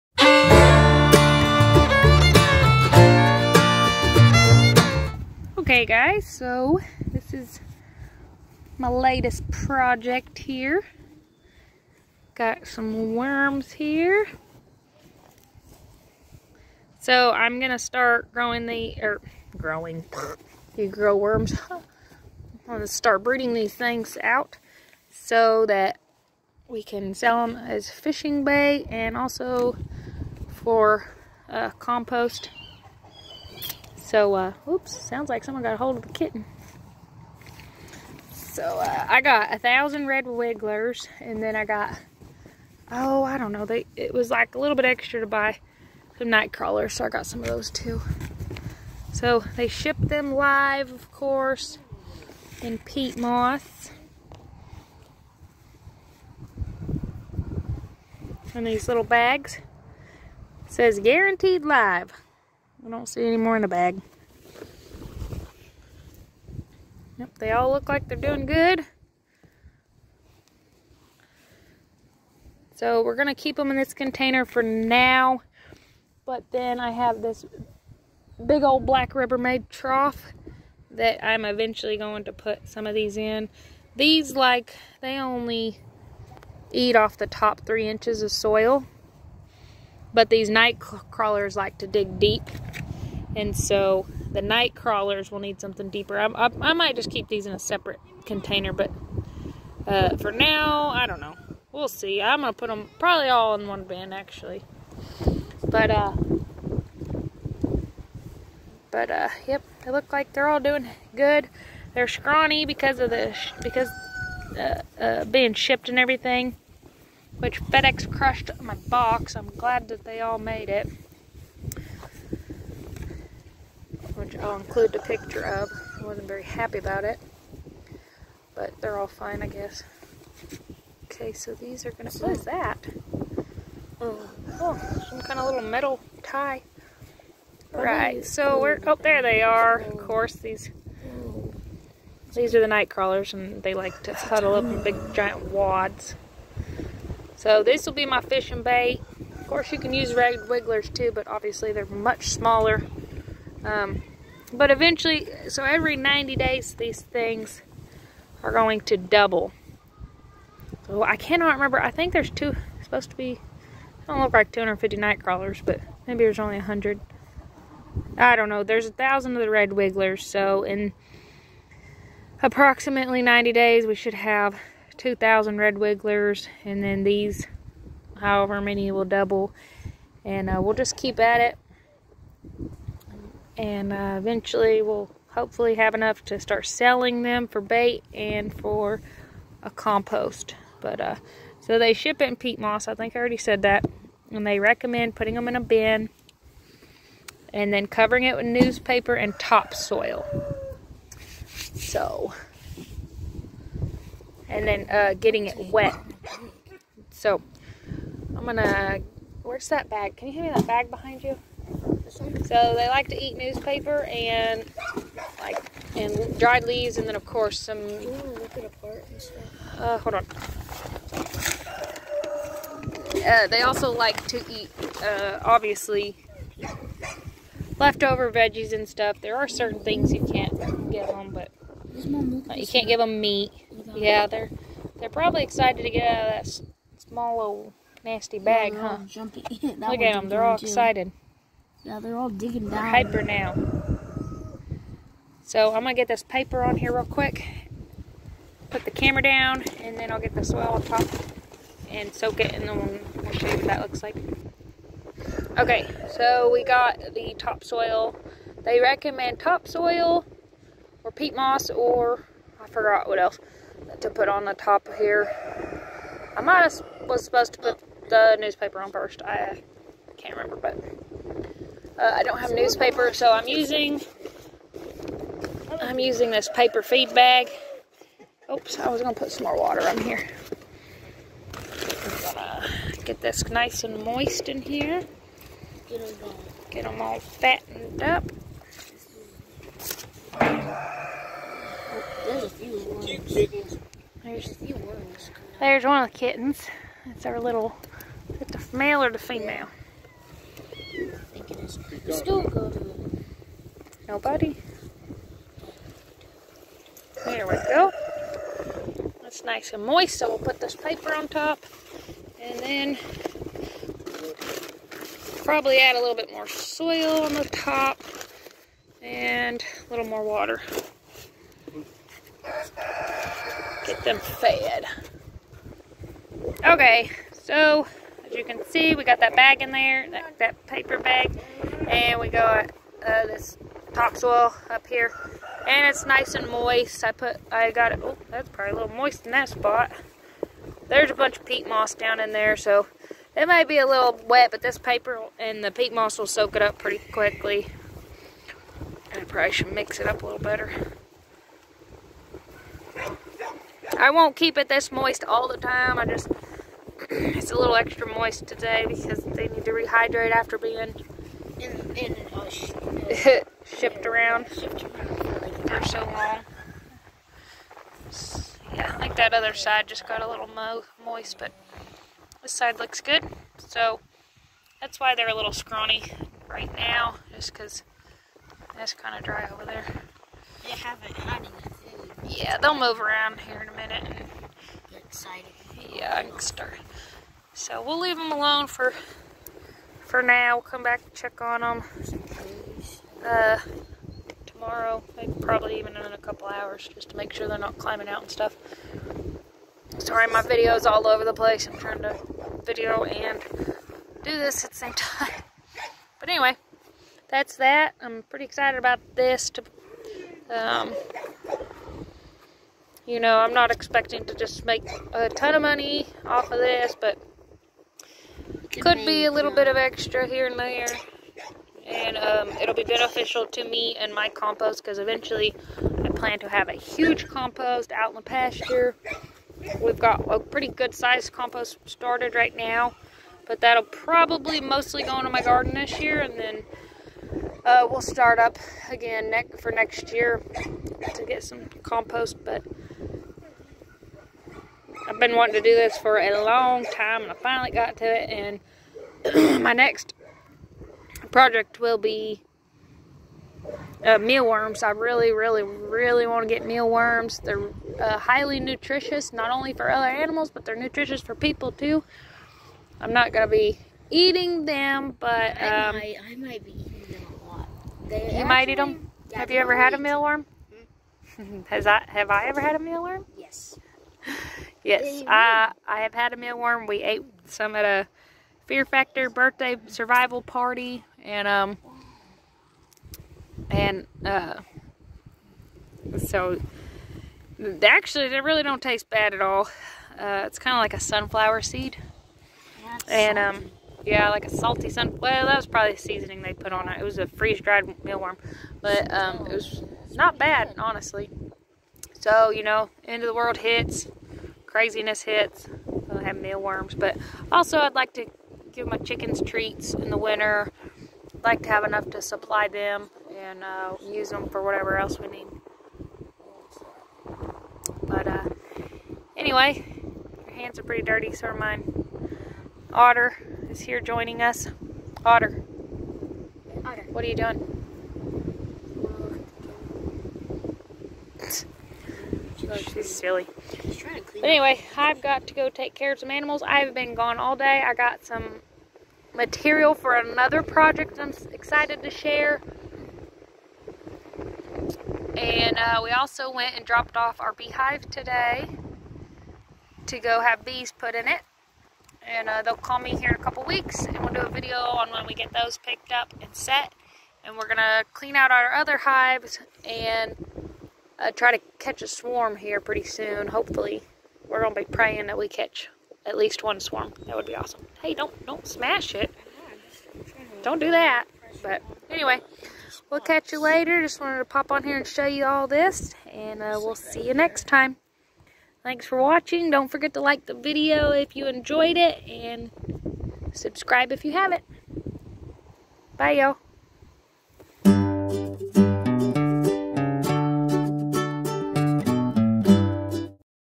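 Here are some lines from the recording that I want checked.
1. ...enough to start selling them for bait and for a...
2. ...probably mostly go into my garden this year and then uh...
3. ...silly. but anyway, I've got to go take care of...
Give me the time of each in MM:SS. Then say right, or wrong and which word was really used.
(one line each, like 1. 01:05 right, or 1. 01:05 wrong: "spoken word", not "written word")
1. 03:05 right
2. 07:13 right
3. 08:53 right.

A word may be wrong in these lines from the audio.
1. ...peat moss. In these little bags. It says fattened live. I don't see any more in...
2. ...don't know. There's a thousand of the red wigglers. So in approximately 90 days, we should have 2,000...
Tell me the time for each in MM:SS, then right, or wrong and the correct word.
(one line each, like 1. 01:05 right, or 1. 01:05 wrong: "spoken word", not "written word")
1. 00:52 wrong: "guaranteed", not "fattened"
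2. 02:48 right.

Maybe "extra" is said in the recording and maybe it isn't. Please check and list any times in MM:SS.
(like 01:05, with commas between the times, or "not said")
00:44, 05:57, 06:59.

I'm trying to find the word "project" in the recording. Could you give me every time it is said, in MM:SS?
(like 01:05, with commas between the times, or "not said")
00:09, 07:31, 09:00.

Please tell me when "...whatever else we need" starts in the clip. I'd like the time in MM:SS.
08:34.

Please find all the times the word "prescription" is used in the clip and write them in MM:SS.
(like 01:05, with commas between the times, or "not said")
not said.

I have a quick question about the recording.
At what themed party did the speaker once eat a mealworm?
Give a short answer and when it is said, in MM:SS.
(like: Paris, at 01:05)
Fear Factor birthday survival party, at 07:58.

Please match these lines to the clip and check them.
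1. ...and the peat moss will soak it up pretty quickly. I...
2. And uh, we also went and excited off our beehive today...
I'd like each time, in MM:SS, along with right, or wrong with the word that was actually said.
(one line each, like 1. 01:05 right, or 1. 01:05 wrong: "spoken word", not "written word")
1. 05:45 right
2. 09:05 wrong: "dropped", not "excited".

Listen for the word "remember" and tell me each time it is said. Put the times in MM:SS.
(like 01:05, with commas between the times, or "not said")
02:41, 04:30.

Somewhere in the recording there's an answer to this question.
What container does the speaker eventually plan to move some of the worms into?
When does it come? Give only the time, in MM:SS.
01:18.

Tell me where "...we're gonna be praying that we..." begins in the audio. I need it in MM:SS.
09:24.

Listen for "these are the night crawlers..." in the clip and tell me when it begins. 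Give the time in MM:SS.
02:22.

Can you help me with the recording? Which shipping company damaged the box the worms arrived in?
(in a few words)
FedEx.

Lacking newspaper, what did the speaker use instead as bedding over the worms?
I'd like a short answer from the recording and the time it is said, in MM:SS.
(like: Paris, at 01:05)
Paper feed bag, at 04:36.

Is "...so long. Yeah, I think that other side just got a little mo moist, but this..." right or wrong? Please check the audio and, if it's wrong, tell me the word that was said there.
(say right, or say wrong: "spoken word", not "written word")
right.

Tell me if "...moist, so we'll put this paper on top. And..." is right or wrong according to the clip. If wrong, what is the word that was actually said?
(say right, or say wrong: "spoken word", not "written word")
right.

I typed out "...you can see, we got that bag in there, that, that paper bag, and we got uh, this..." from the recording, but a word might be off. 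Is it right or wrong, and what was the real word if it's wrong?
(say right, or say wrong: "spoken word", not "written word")
right.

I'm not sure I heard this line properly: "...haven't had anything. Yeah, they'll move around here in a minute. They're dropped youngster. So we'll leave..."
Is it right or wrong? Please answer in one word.
wrong.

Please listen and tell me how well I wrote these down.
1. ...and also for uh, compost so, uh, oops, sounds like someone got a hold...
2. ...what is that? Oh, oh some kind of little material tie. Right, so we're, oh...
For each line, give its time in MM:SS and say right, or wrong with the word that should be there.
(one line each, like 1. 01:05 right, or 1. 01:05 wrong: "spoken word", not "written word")
1. 00:28 right
2. 02:12 wrong: "metal", not "material".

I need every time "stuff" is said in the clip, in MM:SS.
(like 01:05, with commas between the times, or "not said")
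03:48, 06:38.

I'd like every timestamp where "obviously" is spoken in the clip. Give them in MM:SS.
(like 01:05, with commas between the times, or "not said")
02:31, 03:45.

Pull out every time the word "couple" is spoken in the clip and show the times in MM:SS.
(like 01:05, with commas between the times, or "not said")
06:36, 09:13.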